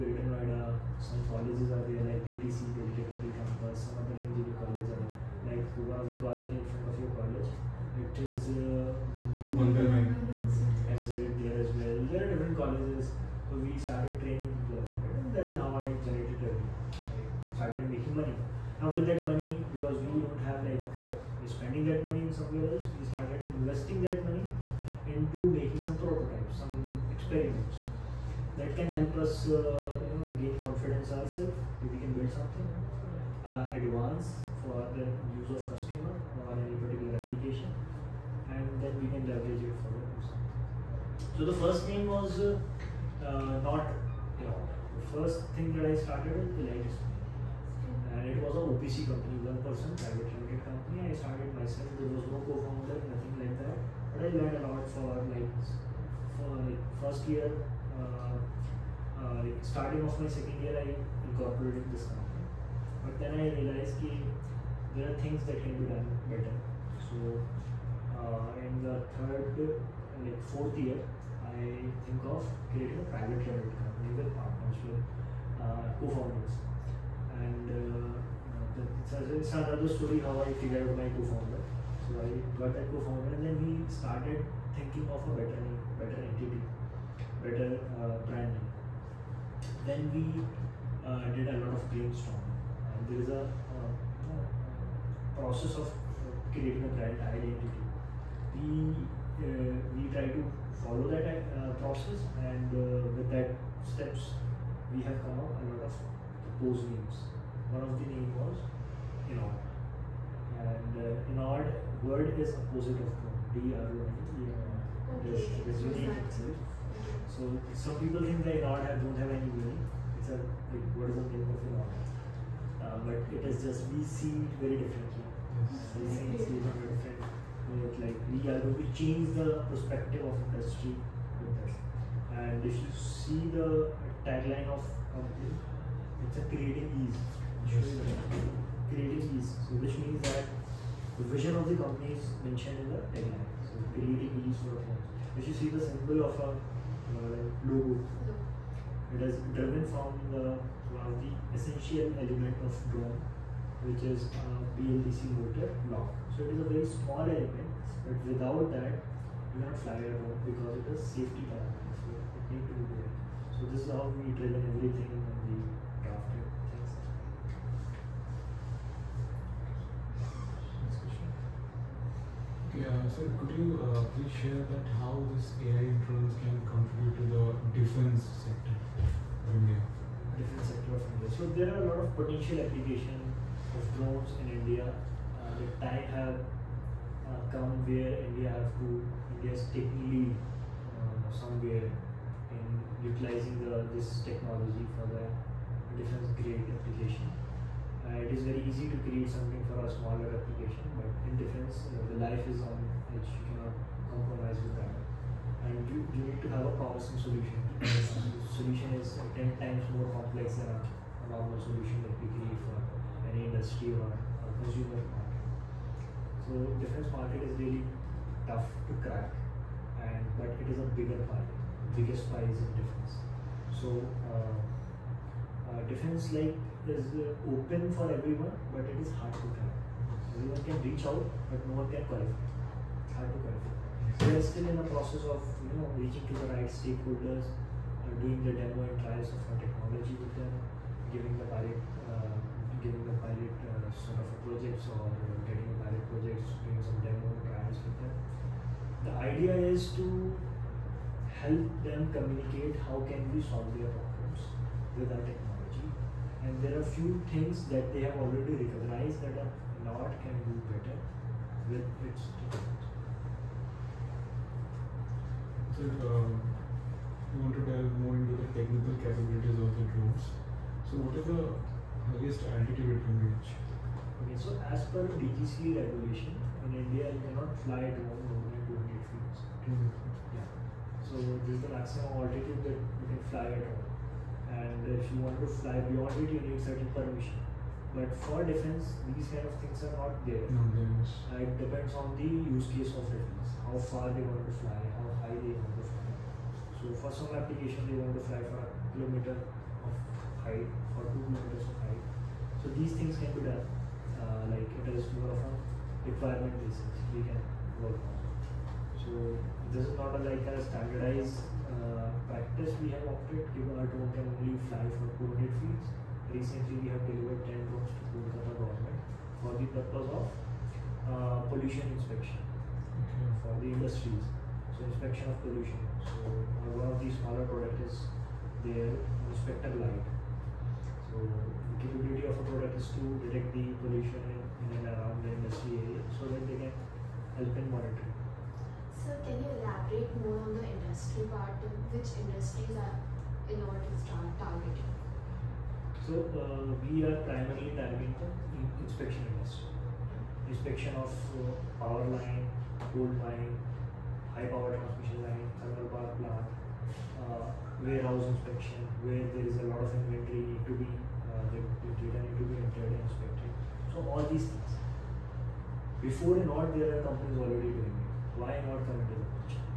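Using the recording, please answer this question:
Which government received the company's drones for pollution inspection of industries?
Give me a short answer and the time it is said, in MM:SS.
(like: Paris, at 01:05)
Kolkata government, at 05:18.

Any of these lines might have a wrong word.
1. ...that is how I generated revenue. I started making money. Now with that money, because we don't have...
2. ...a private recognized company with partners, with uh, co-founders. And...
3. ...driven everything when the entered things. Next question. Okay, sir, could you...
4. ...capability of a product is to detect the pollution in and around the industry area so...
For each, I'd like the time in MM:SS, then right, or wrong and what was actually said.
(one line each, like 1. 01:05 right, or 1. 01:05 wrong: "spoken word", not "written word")
1. 00:15 right
2. 01:12 wrong: "limited", not "recognized"
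3. 02:44 wrong: "drafted", not "entered"
4. 05:31 right.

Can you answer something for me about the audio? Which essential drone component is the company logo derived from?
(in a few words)
BLDC motor.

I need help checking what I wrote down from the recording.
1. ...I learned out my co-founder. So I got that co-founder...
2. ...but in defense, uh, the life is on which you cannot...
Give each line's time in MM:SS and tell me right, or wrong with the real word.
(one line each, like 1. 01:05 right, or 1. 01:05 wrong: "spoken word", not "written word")
1. 01:20 wrong: "figured", not "learned"
2. 03:20 right.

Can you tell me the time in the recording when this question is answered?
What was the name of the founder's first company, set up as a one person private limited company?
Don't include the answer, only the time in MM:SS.
00:46.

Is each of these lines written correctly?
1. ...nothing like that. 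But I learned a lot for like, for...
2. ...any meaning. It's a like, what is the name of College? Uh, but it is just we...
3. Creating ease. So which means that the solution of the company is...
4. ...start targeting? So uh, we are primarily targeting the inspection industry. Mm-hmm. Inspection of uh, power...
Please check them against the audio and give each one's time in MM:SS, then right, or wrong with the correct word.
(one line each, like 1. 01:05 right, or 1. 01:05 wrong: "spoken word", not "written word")
1. 00:53 right
2. 01:59 wrong: "Enord", not "College"
3. 02:18 wrong: "vision", not "solution"
4. 05:43 right.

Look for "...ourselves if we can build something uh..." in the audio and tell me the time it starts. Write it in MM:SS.
00:31.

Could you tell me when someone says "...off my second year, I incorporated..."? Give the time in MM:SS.
01:00.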